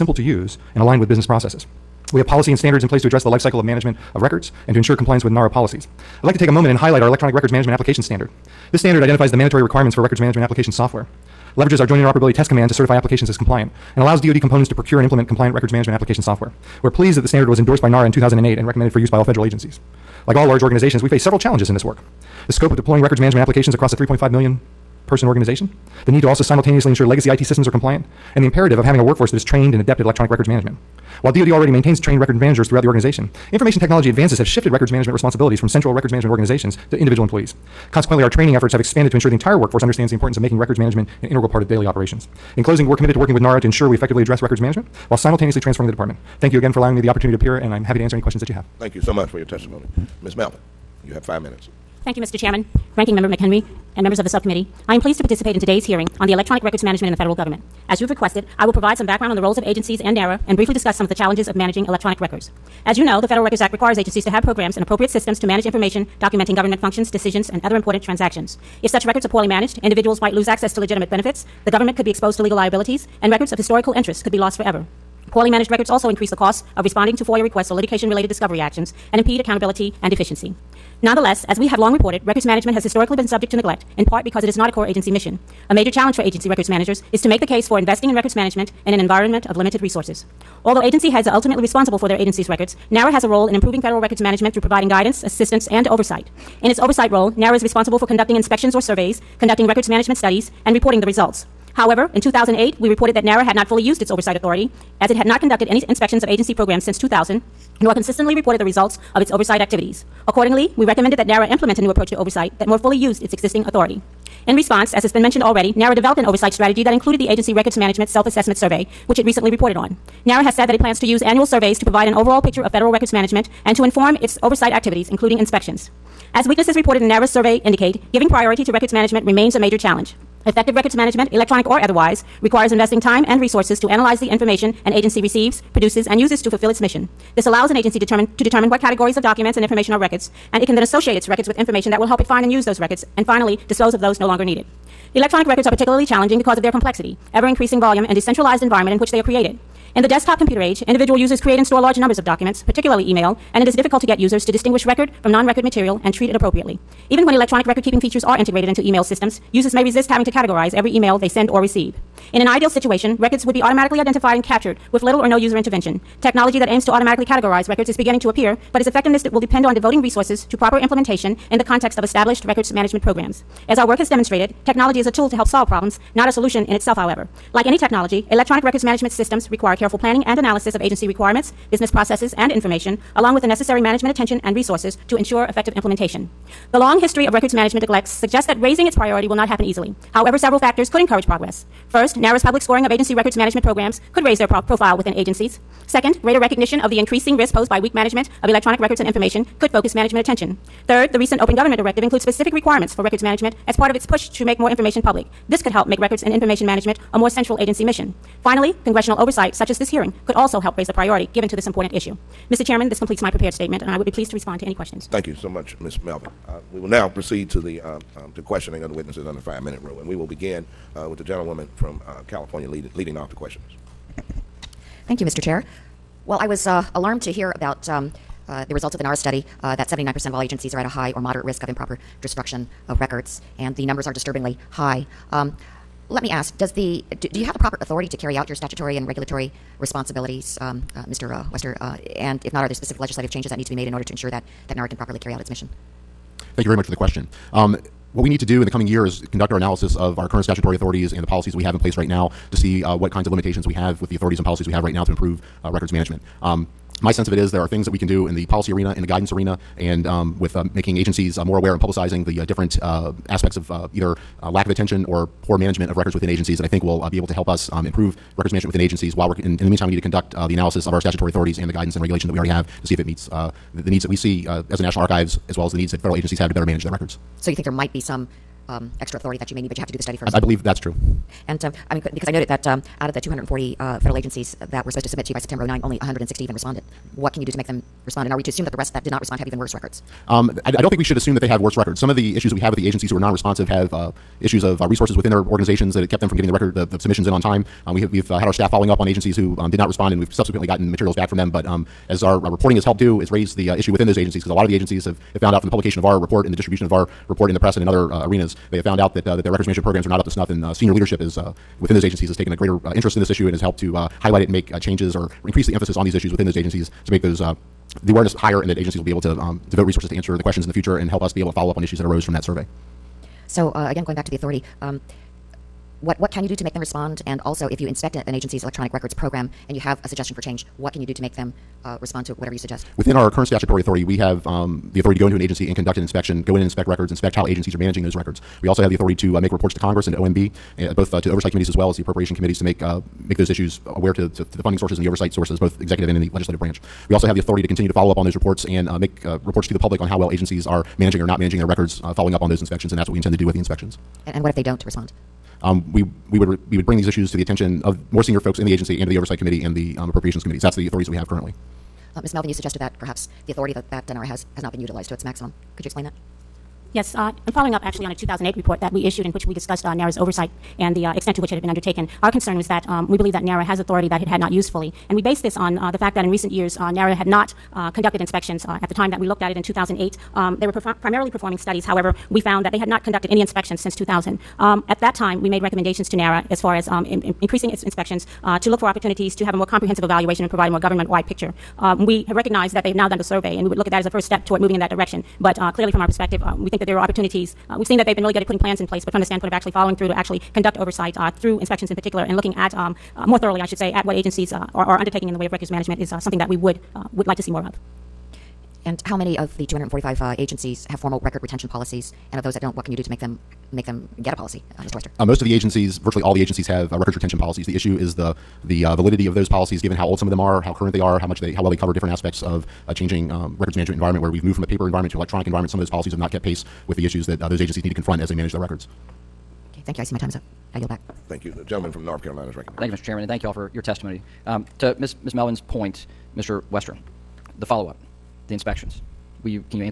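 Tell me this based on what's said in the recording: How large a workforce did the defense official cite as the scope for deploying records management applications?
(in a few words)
3.5 million.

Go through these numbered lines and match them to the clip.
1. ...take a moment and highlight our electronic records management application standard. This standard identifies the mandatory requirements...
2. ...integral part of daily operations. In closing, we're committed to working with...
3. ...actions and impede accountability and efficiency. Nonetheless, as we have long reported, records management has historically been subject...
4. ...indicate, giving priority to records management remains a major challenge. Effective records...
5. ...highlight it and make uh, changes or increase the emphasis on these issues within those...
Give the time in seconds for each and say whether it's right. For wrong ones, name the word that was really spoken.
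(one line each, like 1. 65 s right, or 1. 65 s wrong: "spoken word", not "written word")
1. 6 s right
2. 41 s right
3. 78 s right
4. 127 s right
5. 314 s right.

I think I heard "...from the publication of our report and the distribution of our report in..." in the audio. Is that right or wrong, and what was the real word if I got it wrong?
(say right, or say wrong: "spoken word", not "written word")
right.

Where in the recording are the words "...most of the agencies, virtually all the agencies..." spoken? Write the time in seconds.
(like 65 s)
415 s.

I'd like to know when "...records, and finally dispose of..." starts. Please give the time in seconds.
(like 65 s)
142 s.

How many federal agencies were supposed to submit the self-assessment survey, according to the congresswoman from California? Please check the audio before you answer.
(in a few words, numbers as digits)
240.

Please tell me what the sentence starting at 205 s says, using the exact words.
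This could help make records and information management a more central agency mission.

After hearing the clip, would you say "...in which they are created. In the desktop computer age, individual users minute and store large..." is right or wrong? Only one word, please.
wrong.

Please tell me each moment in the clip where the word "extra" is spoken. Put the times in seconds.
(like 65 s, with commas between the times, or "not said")
278 s.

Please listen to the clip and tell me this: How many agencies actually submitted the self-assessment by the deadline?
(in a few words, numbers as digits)
160.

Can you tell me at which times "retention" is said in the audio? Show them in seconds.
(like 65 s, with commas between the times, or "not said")
411 s, 417 s.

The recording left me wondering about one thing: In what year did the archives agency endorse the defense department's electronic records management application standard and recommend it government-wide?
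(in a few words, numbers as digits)
2008.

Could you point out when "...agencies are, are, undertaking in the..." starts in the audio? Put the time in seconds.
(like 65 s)
404 s.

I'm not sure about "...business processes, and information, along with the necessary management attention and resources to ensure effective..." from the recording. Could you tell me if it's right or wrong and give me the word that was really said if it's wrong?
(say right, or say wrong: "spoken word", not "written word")
right.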